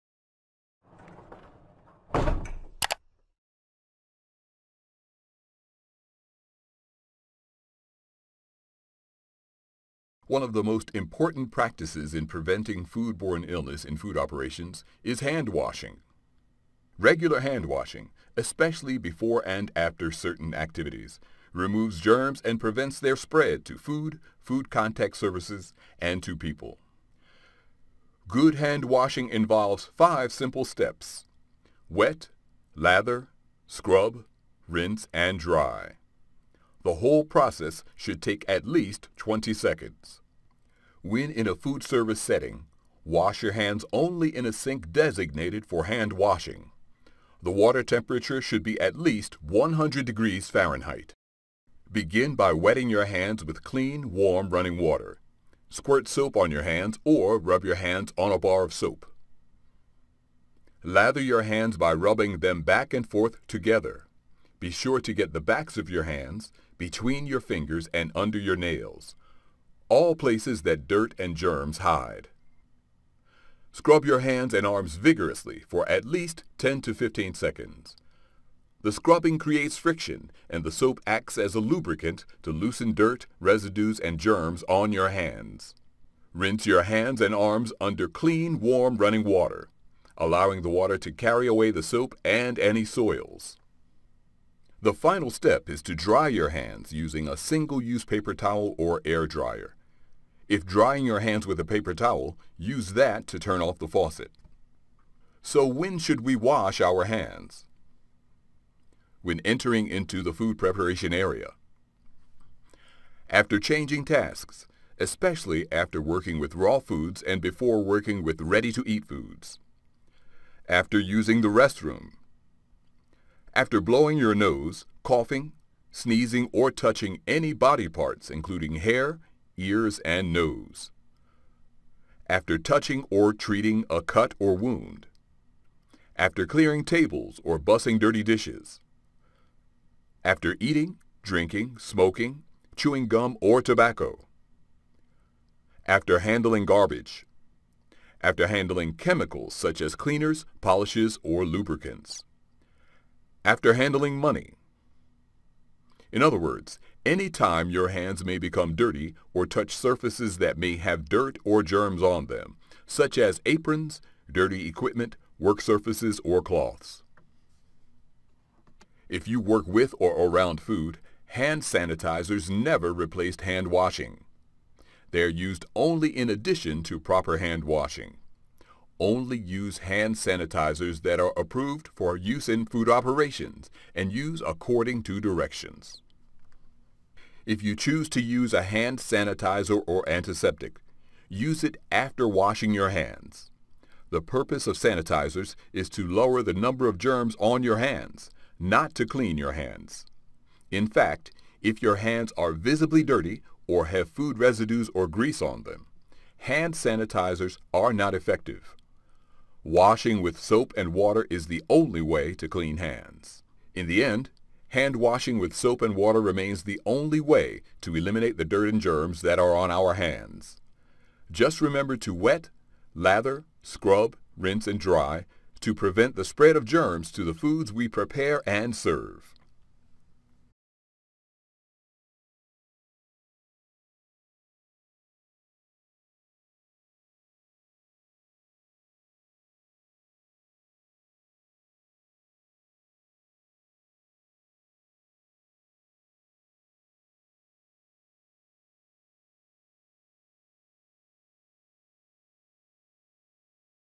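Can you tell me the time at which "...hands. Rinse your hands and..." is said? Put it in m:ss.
1:25.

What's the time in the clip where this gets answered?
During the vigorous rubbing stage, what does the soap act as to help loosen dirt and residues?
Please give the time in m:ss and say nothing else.
1:21.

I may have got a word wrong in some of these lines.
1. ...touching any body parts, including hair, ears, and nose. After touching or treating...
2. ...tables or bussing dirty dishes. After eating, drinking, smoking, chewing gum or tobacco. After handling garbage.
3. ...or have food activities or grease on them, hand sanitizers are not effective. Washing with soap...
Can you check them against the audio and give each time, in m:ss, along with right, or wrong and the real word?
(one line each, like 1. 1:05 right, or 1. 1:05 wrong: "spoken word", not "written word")
1. 2:06 right
2. 2:16 right
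3. 3:23 wrong: "residues", not "activities".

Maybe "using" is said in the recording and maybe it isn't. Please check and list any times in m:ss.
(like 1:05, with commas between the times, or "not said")
1:36, 2:00.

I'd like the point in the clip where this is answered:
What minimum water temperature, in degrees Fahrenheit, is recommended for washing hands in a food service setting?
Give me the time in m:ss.
0:49.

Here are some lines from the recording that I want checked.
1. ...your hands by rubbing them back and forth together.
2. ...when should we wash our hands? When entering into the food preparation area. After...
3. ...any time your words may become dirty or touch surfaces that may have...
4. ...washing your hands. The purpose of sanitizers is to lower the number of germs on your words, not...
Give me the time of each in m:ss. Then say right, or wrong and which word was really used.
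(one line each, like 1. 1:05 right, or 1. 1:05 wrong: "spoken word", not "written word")
1. 1:01 right
2. 1:45 right
3. 2:37 wrong: "hands", not "words"
4. 3:12 wrong: "hands", not "words".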